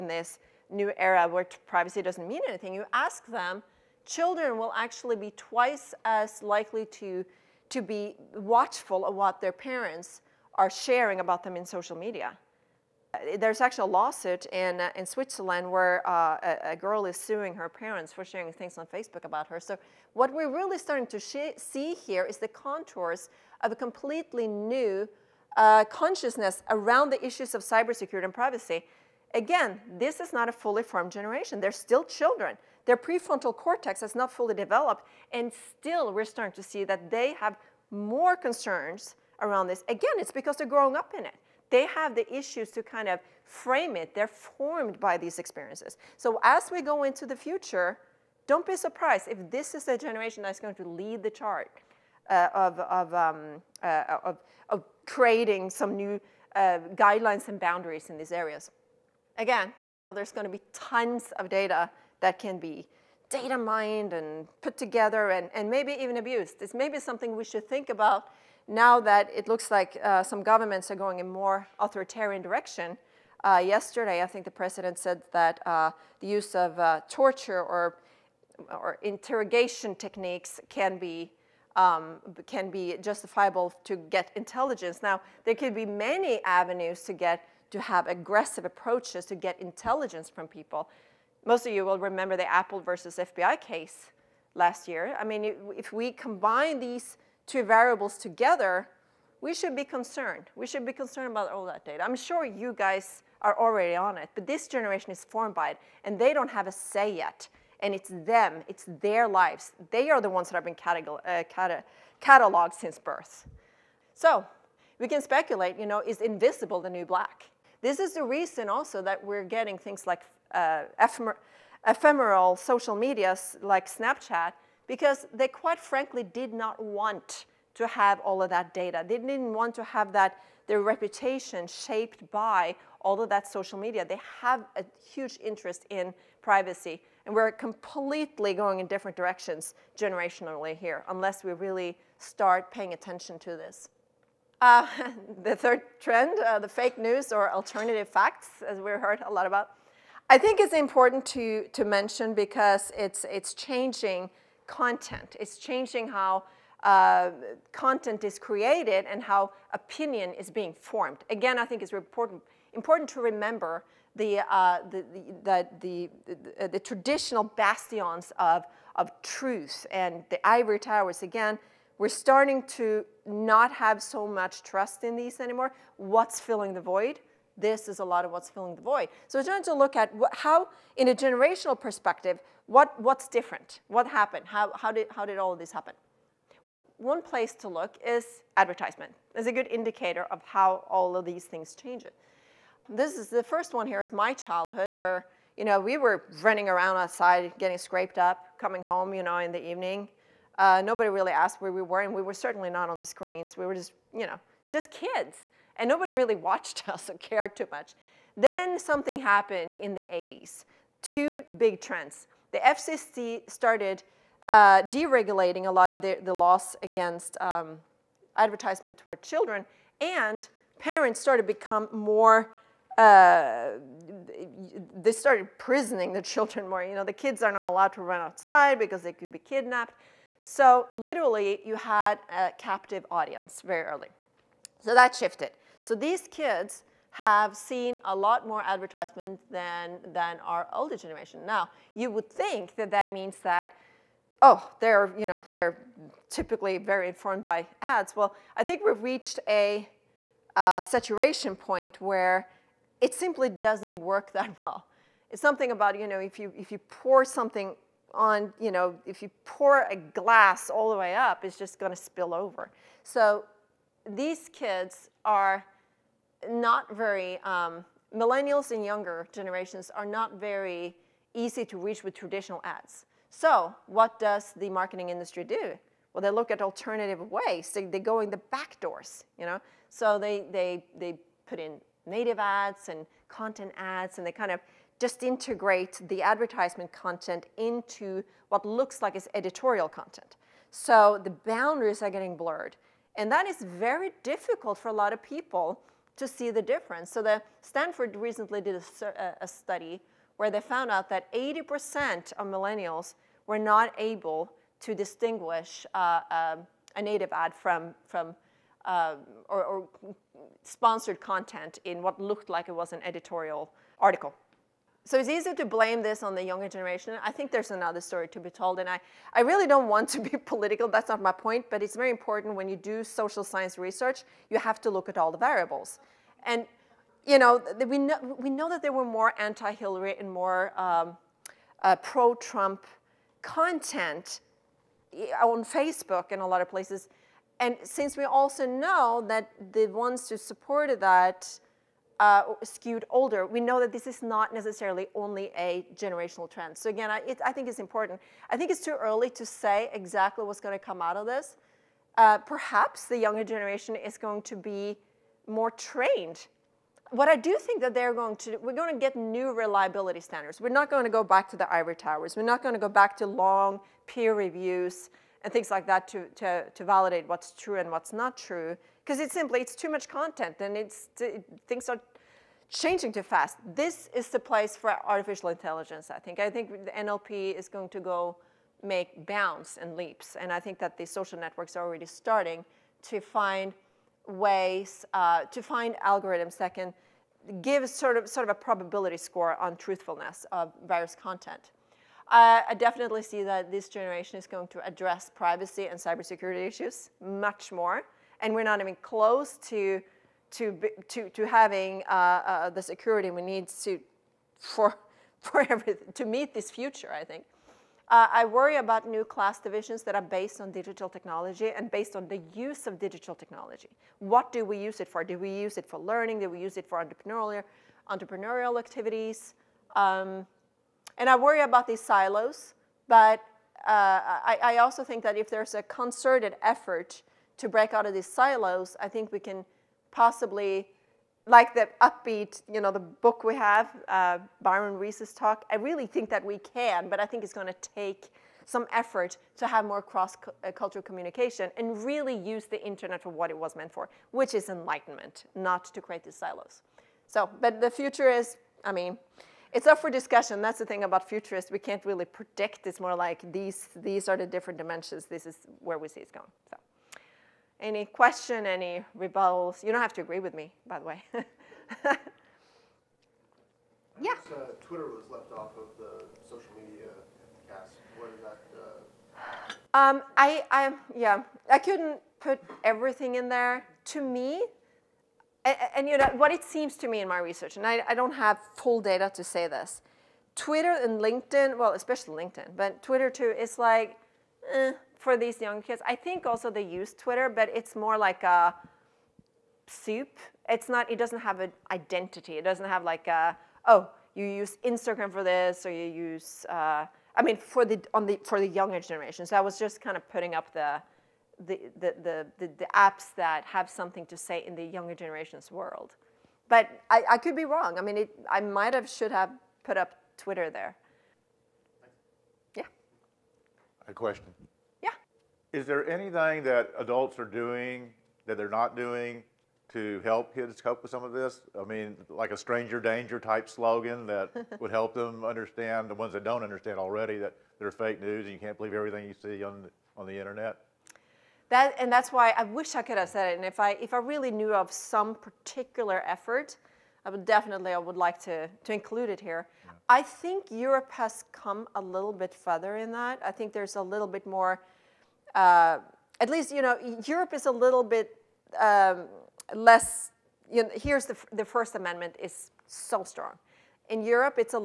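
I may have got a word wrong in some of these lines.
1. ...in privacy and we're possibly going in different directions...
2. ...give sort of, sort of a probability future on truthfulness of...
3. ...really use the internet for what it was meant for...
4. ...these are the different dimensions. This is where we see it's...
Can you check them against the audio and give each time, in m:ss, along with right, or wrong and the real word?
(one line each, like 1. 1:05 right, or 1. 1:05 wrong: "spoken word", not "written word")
1. 2:15 wrong: "completely", not "possibly"
2. 6:27 wrong: "score", not "future"
3. 7:22 right
4. 7:33 right.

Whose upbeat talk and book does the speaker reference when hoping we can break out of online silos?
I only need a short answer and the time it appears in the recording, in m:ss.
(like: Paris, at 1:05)
Byron Reese, at 7:14.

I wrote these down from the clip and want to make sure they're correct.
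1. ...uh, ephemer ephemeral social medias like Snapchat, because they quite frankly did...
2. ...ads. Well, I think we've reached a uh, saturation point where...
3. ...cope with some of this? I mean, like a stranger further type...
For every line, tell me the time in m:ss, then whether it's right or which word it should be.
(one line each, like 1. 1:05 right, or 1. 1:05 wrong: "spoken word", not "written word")
1. 2:00 right
2. 4:07 right
3. 8:40 wrong: "danger", not "further".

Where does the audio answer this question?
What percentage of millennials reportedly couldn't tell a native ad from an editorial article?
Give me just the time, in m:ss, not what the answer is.
5:01.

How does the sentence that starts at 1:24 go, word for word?
Now, there could be many avenues to get to have aggressive approaches to get intelligence from people.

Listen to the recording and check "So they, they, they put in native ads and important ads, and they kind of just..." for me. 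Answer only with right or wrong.
wrong.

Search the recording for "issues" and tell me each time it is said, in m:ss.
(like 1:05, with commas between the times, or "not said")
0:27, 0:42, 6:36.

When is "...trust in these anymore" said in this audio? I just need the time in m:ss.
2:54.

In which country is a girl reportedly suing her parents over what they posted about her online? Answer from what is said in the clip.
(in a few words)
Switzerland.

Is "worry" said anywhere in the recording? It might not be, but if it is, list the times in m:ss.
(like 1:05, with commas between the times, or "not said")
6:48, 7:01.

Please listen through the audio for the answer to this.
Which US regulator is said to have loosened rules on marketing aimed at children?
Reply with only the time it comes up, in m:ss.
3:32.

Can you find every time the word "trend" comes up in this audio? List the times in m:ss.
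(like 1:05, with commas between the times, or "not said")
2:25, 3:31, 5:46.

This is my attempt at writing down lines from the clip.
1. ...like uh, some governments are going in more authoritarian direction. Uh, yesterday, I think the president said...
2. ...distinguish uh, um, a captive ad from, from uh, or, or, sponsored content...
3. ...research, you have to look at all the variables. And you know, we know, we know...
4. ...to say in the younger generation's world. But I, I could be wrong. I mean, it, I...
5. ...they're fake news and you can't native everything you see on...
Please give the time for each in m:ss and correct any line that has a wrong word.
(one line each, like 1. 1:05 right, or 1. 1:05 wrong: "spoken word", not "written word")
1. 1:09 right
2. 5:04 wrong: "native", not "captive"
3. 5:23 right
4. 8:24 right
5. 8:47 wrong: "believe", not "native".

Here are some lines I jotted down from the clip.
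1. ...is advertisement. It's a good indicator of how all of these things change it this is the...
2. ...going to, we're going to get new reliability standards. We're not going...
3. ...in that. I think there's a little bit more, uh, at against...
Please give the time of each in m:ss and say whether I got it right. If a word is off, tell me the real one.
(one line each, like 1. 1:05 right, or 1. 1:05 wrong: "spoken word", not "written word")
1. 3:08 right
2. 5:58 right
3. 9:02 wrong: "least", not "against".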